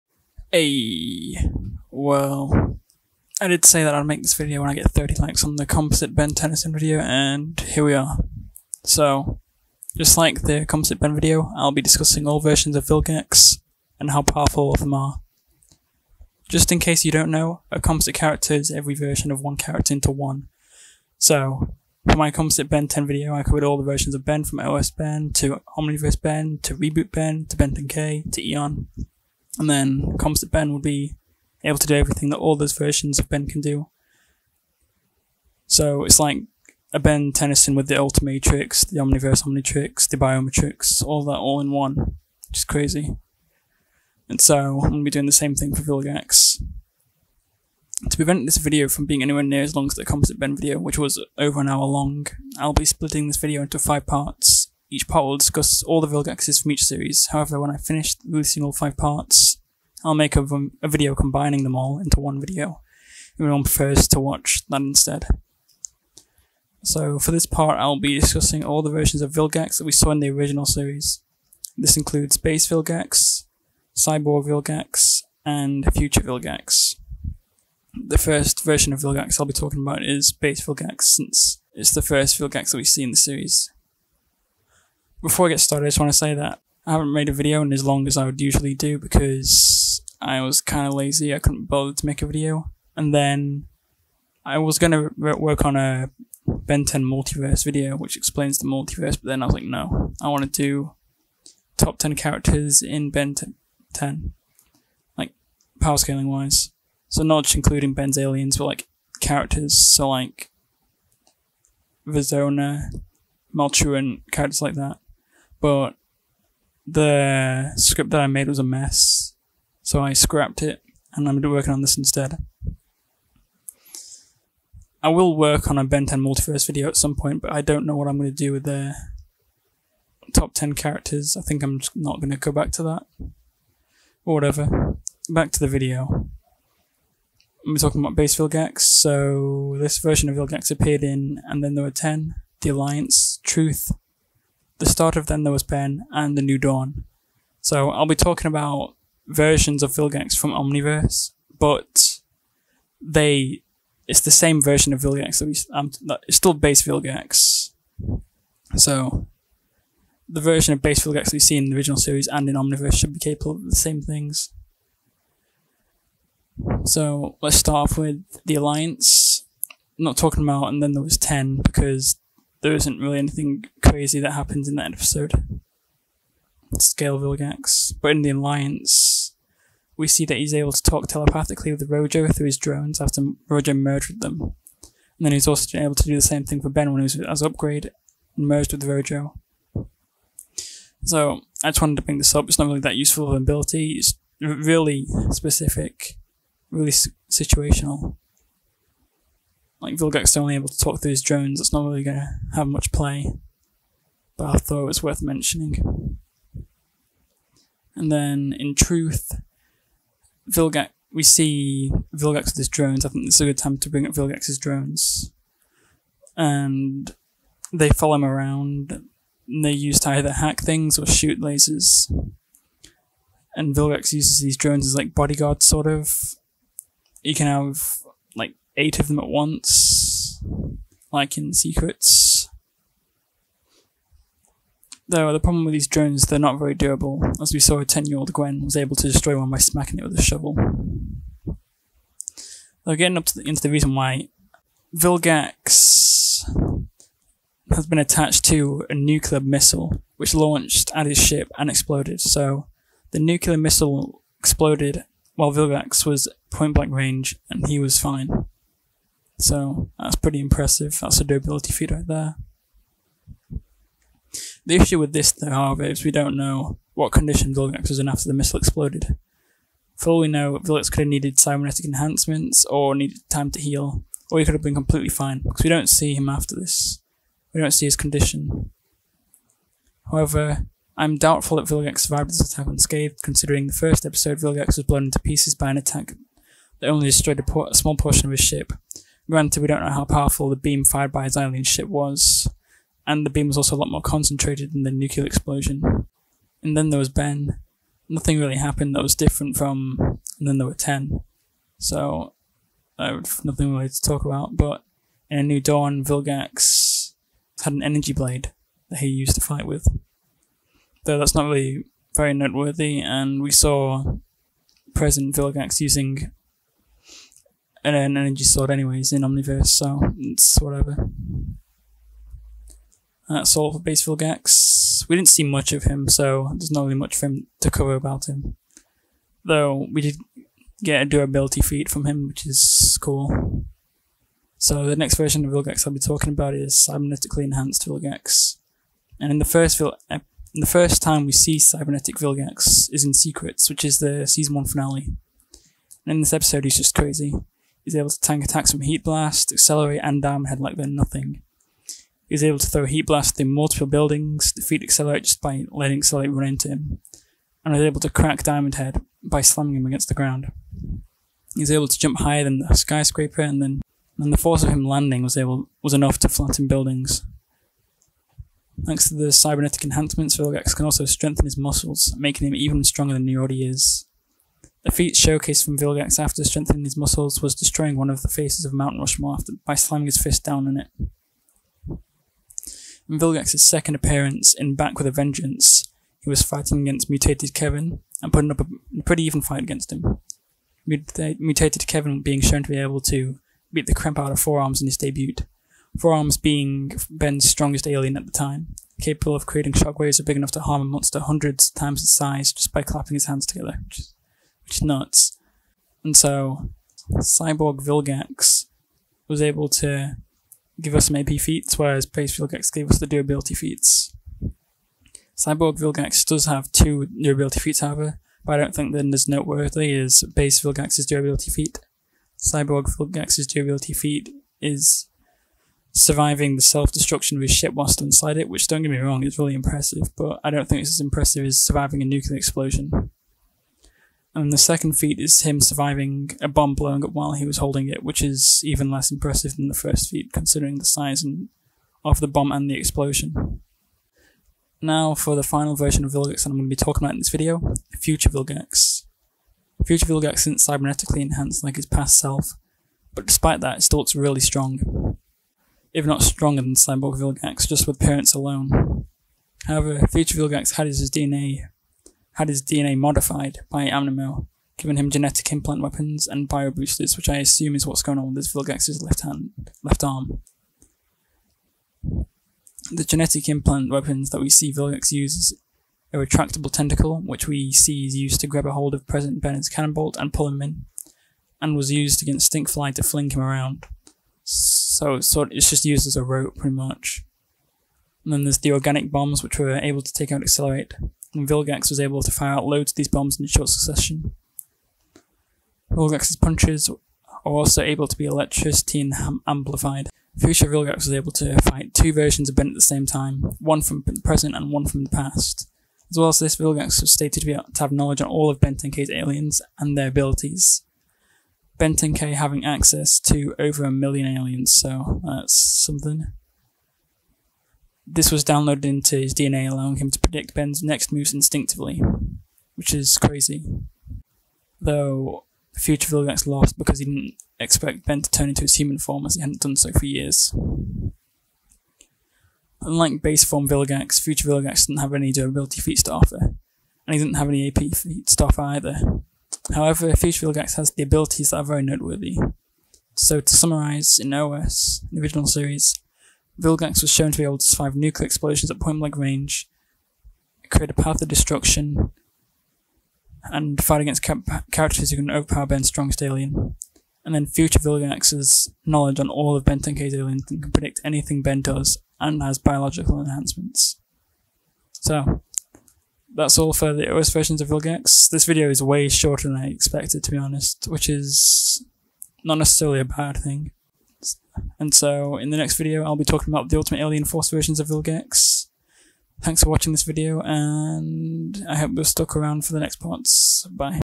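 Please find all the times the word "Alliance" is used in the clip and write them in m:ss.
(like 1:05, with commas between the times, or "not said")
2:22, 2:48, 2:58.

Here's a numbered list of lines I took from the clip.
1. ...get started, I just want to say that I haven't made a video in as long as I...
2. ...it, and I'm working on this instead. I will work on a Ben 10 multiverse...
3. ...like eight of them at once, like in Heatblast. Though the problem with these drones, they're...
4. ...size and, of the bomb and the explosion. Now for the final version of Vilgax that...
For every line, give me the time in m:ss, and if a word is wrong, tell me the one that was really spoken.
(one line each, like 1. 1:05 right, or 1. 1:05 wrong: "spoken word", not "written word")
1. 1:25 right
2. 2:00 right
3. 3:48 wrong: "Secrets", not "Heatblast"
4. 7:20 right.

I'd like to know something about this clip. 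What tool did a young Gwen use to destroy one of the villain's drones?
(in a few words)
A shovel.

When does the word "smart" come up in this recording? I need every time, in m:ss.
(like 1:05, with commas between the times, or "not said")
not said.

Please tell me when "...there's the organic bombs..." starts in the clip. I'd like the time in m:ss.
8:08.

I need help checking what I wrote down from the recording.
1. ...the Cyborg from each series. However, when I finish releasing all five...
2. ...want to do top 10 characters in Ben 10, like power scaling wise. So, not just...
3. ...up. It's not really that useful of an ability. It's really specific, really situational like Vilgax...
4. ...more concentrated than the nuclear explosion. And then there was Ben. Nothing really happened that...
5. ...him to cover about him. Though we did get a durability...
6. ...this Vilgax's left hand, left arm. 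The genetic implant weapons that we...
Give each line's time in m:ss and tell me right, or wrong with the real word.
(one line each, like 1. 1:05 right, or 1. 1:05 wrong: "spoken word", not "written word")
1. 0:56 wrong: "Vilgaxes", not "Cyborg"
2. 1:40 right
3. 3:12 right
4. 4:53 right
5. 5:27 right
6. 7:48 right.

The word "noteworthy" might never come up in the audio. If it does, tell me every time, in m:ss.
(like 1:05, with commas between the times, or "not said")
5:12, 6:59, 9:01.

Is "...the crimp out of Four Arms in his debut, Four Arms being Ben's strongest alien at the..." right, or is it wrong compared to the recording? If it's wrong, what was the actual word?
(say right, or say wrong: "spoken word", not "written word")
right.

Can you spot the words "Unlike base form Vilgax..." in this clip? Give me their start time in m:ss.
8:52.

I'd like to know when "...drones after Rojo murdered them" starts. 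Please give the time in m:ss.
3:02.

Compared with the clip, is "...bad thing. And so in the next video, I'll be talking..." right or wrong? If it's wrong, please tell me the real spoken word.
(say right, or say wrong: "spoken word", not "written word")
right.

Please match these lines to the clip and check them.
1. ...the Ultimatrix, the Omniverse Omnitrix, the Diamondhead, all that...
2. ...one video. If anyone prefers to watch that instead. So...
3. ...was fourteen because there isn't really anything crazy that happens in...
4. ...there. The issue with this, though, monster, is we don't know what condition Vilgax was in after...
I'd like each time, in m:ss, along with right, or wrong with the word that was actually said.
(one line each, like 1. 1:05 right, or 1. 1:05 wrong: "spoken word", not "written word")
1. 0:37 wrong: "Biomatrix", not "Diamondhead"
2. 1:02 right
3. 2:51 wrong: "ten", not "fourteen"
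4. 4:22 wrong: "however", not "monster".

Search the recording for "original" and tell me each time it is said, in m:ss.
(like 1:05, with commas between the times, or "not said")
1:10, 2:41, 9:05.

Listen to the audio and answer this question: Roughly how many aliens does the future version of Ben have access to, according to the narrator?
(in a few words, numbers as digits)
Over a million.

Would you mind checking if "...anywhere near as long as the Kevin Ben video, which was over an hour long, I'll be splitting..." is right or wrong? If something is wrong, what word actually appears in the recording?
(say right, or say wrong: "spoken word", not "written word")
wrong: "Composite", not "Kevin".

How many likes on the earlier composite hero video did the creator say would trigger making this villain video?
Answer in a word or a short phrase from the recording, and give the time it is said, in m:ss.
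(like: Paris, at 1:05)
30, at 0:04.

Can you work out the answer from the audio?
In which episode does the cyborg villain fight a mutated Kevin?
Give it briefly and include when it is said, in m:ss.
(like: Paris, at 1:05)
Back with a Vengeance, at 6:24.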